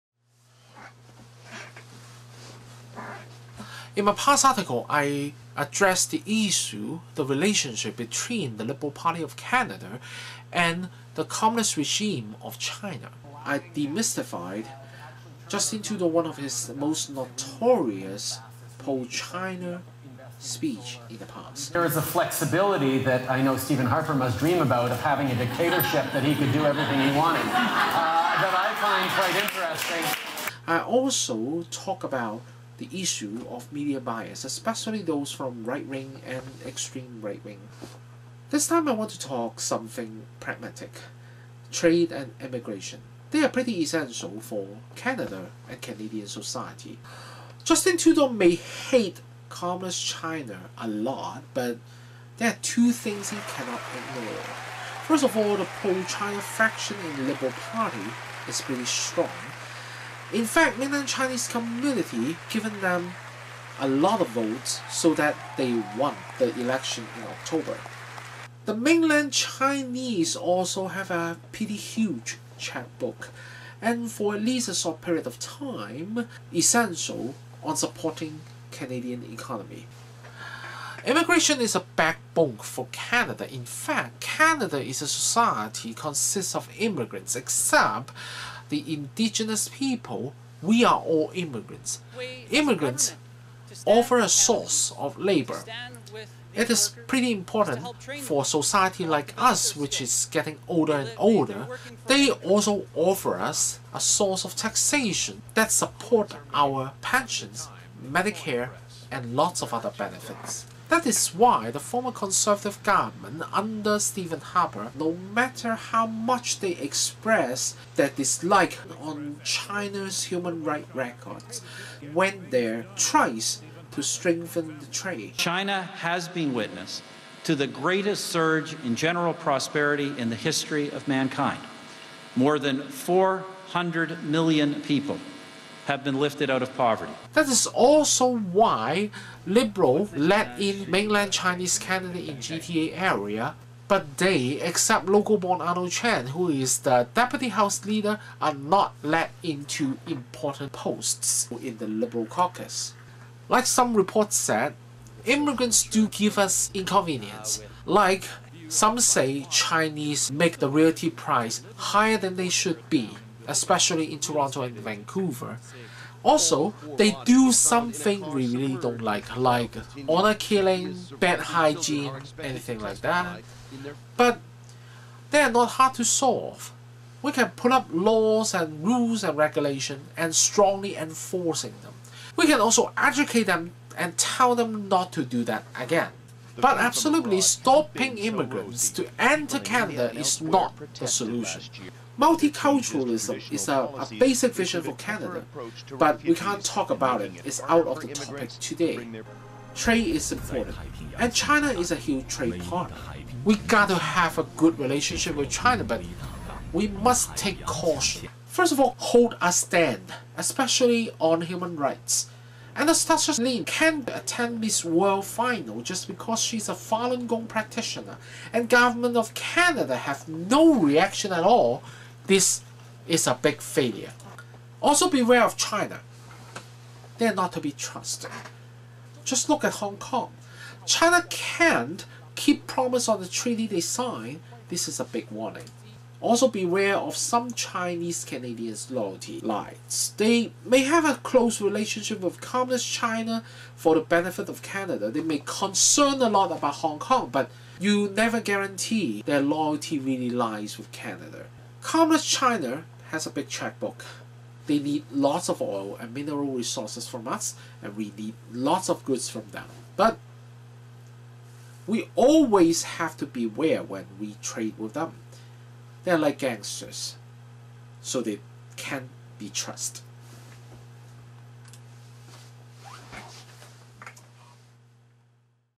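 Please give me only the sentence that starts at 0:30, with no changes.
I also talk about the issue of media bias, especially those from right wing and extreme right wing.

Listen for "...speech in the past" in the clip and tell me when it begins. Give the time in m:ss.
0:20.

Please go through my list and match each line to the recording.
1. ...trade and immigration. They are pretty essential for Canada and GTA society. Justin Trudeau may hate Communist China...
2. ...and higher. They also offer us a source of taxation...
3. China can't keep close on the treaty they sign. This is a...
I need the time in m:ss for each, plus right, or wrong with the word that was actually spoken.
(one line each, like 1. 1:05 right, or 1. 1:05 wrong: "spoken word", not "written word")
1. 0:41 wrong: "Canadian", not "GTA"
2. 1:40 wrong: "older", not "higher"
3. 3:50 wrong: "promise", not "close".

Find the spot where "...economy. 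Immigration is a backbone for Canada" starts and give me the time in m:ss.
1:19.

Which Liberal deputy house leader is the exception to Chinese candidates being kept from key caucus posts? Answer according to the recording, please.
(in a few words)
Arnold Chan.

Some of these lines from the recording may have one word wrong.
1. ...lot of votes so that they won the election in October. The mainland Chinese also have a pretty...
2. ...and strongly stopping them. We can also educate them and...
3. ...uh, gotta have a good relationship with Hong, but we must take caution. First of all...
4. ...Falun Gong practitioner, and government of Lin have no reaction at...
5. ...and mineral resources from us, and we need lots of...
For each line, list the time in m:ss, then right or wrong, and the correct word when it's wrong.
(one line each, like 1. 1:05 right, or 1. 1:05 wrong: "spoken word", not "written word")
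1. 1:03 right
2. 3:00 wrong: "enforcing", not "stopping"
3. 3:23 wrong: "China", not "Hong"
4. 3:36 wrong: "Canada", not "Lin"
5. 4:15 right.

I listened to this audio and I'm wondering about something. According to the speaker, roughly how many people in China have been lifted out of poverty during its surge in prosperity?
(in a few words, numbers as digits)
400 million.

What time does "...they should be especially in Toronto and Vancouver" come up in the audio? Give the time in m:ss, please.
2:42.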